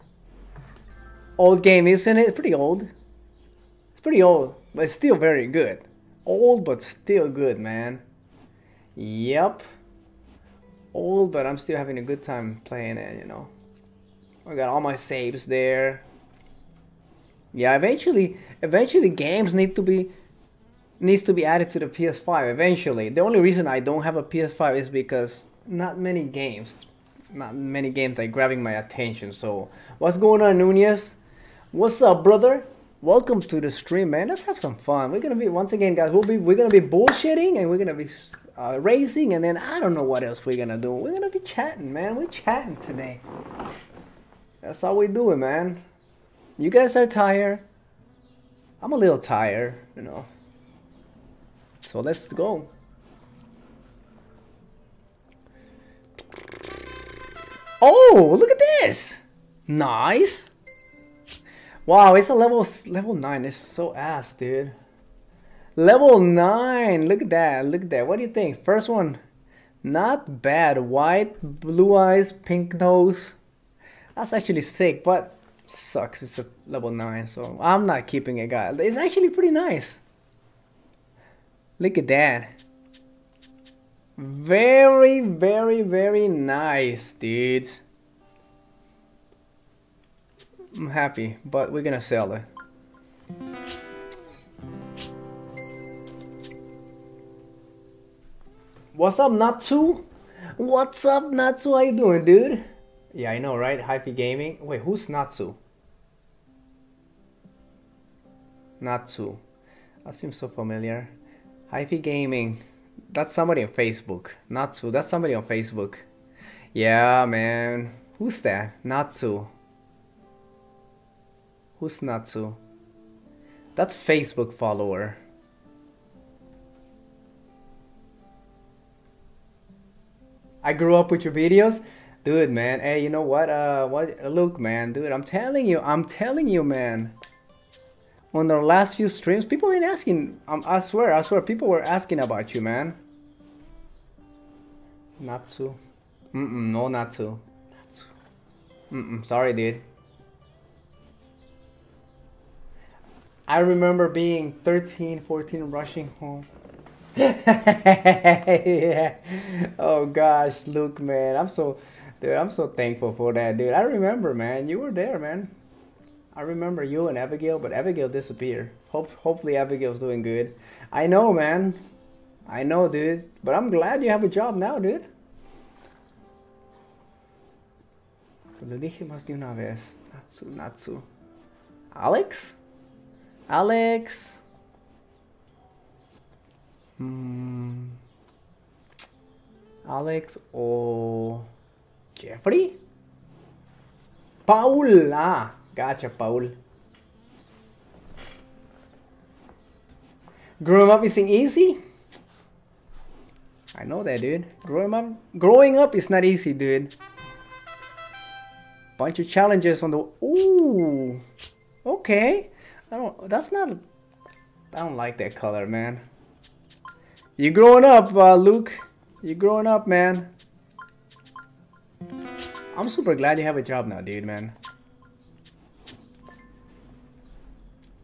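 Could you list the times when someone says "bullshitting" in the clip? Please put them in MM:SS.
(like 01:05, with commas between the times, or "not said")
00:36.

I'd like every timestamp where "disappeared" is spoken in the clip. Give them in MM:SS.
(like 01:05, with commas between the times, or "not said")
02:48.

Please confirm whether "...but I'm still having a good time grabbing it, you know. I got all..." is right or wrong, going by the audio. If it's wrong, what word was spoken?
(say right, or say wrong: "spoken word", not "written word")
wrong: "playing", not "grabbing".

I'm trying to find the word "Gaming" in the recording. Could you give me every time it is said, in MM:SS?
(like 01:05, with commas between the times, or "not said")
01:44, 01:52.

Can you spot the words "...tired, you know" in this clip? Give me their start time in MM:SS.
00:49.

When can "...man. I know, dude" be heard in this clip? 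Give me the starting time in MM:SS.
02:51.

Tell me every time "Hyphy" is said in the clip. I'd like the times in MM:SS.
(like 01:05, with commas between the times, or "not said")
01:43, 01:51.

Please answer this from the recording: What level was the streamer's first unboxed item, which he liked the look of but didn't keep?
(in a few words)
9.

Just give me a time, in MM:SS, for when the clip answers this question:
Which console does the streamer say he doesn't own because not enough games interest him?
00:23.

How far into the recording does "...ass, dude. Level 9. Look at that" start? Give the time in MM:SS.
01:03.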